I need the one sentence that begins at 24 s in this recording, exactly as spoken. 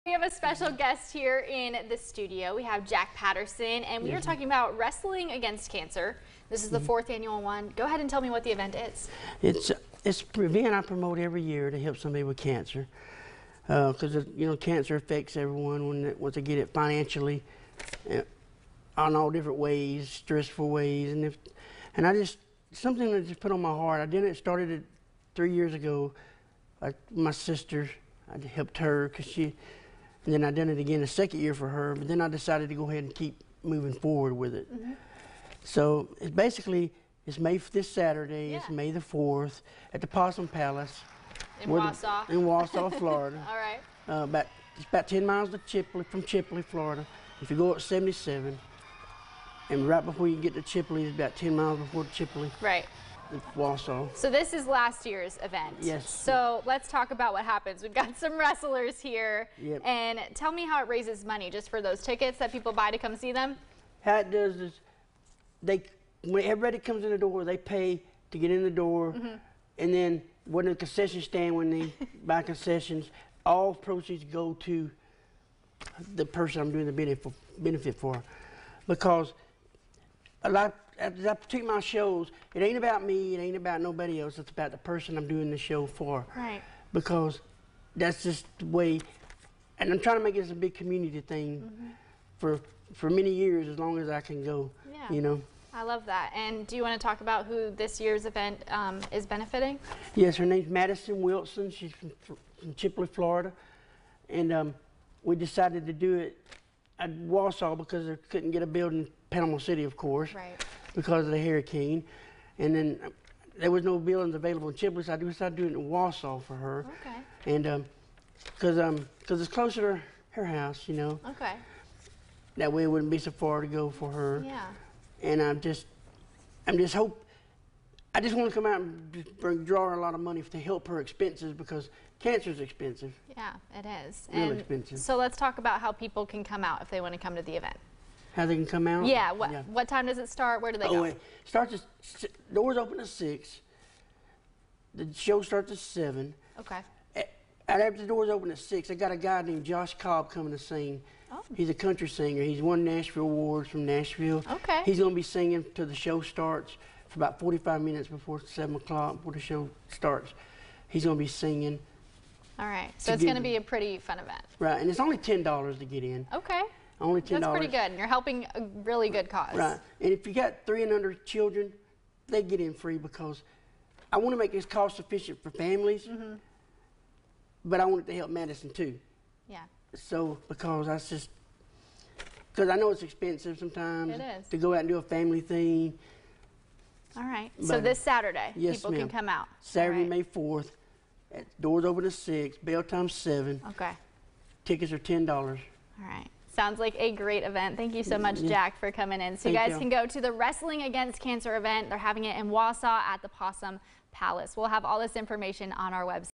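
I did it started it three years ago.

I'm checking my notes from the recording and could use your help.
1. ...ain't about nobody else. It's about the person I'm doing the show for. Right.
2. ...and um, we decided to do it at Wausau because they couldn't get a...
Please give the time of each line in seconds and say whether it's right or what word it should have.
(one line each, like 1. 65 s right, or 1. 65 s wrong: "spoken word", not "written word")
1. 83 s right
2. 104 s right.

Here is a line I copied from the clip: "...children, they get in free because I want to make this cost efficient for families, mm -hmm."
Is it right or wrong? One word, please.
right.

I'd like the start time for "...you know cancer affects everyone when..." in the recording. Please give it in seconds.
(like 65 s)
14 s.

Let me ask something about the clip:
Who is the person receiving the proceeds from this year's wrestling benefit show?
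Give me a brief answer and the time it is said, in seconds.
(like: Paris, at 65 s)
Madison Wilson, at 100 s.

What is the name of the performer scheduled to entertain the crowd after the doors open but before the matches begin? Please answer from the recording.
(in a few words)
Josh Cobb.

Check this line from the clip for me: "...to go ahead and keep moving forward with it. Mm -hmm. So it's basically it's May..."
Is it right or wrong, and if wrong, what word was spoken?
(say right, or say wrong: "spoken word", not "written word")
right.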